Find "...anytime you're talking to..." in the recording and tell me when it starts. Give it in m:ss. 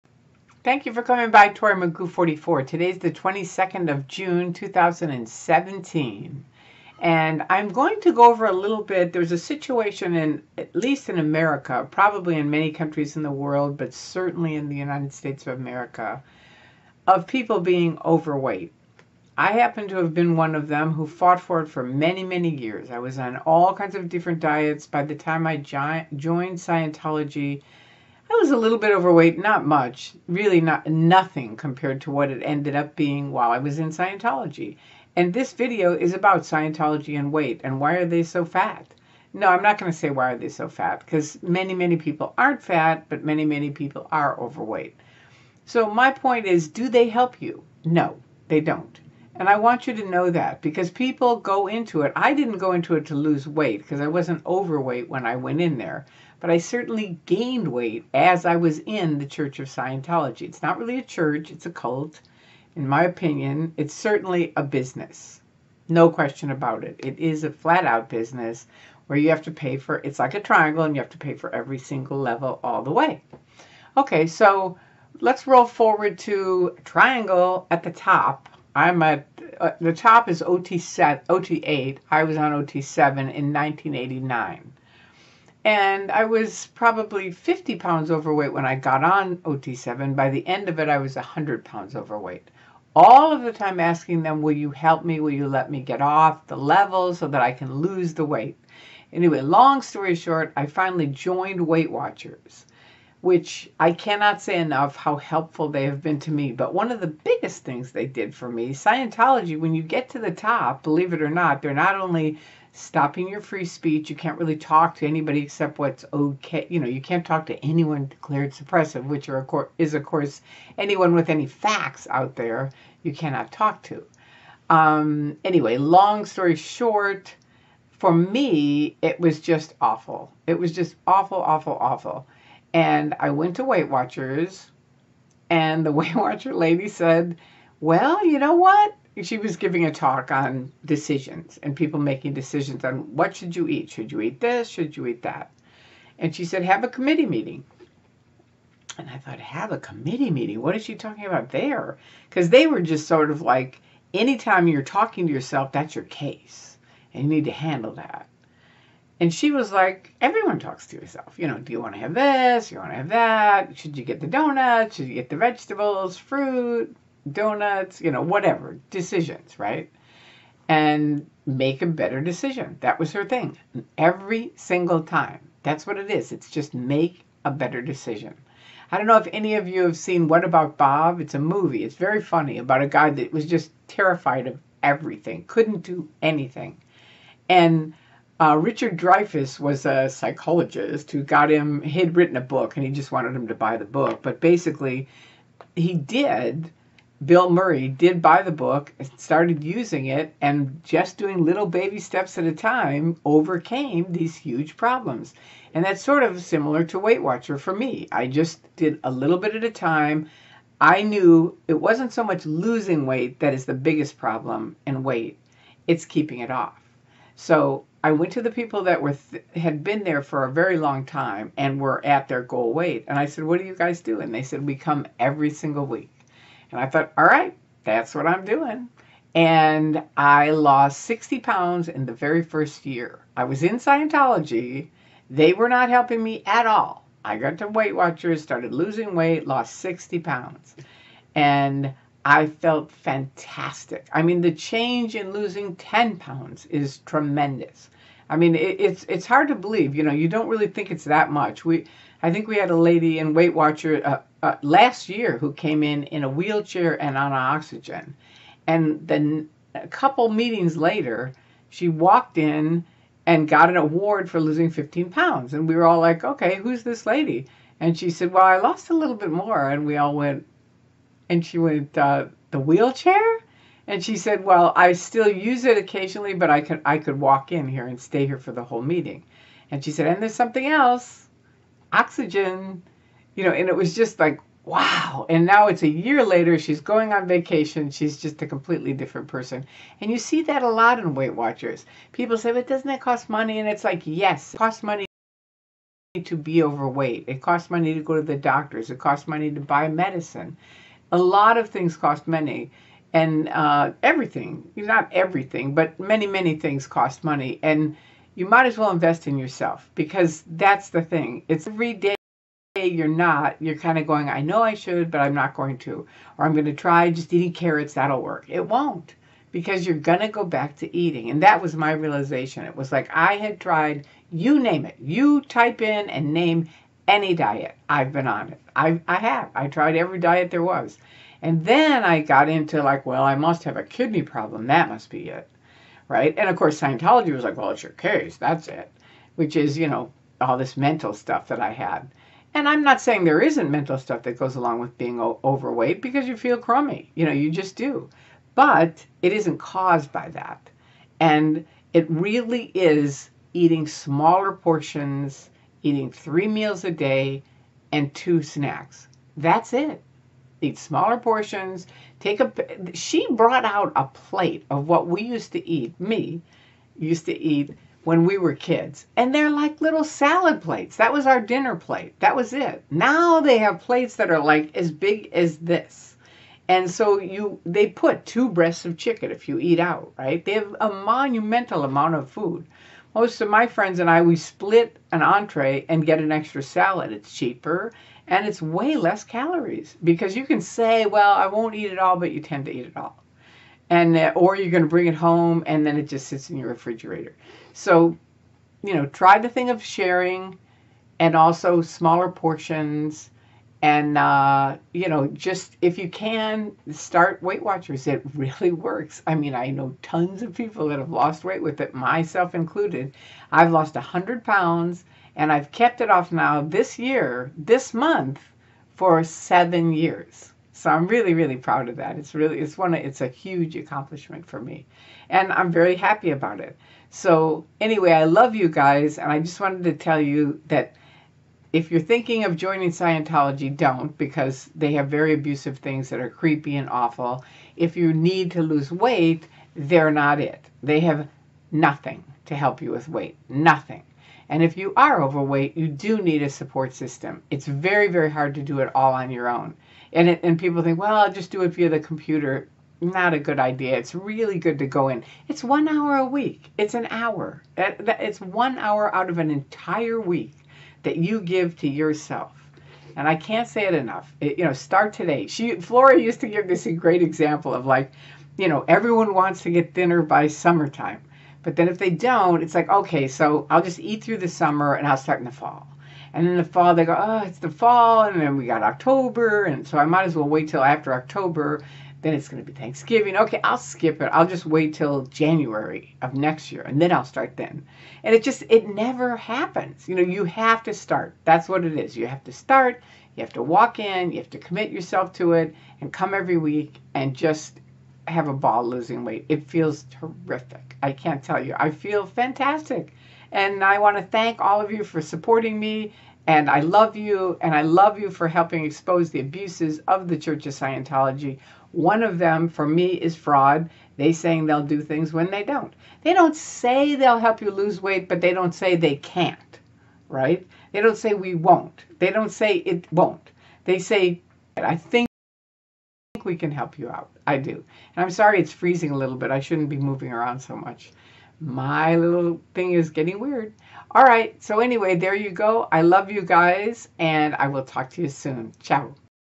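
2:34.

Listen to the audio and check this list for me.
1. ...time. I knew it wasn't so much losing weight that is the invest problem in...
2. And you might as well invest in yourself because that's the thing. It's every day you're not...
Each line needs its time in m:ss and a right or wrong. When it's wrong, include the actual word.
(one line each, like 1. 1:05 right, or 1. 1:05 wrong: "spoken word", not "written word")
1. 3:29 wrong: "biggest", not "invest"
2. 5:07 right.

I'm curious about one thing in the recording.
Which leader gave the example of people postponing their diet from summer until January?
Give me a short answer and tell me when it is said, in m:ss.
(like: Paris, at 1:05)
Flora, at 7:45.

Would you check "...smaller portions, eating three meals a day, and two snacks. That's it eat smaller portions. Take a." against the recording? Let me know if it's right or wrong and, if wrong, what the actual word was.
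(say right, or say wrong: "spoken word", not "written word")
right.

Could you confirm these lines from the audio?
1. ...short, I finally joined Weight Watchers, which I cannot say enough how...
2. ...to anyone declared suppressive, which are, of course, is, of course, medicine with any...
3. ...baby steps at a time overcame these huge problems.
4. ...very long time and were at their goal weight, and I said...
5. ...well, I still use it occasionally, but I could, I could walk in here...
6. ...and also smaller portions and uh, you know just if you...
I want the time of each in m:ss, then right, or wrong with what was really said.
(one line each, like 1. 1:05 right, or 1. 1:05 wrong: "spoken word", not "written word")
1. 1:40 right
2. 1:57 wrong: "anyone", not "medicine"
3. 3:21 right
4. 3:40 right
5. 4:34 right
6. 6:41 right.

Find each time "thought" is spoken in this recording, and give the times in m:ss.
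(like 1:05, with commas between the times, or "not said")
2:29, 3:46.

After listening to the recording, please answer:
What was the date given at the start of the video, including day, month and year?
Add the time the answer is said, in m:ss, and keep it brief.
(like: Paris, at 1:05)
22nd of June 2017, at 0:03.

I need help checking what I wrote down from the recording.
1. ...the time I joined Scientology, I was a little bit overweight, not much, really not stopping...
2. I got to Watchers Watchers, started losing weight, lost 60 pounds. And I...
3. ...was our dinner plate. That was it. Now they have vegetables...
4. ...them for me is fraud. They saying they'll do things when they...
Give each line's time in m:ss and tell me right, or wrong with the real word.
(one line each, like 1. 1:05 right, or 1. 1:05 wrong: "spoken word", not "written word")
1. 0:25 wrong: "nothing", not "stopping"
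2. 3:57 wrong: "Weight", not "Watchers"
3. 6:11 wrong: "plates", not "vegetables"
4. 8:32 right.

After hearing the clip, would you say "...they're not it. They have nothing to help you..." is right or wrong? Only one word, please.
right.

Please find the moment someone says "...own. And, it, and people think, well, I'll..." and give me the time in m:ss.
7:29.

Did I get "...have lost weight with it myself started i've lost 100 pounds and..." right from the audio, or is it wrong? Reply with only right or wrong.
wrong.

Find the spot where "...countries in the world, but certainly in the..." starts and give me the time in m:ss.
0:12.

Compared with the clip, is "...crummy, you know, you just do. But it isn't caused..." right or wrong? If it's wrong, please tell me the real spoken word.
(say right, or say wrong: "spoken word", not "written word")
right.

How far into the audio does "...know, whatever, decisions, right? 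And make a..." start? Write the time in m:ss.
2:48.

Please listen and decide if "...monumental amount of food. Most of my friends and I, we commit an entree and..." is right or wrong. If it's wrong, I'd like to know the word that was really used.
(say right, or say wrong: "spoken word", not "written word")
wrong: "split", not "commit".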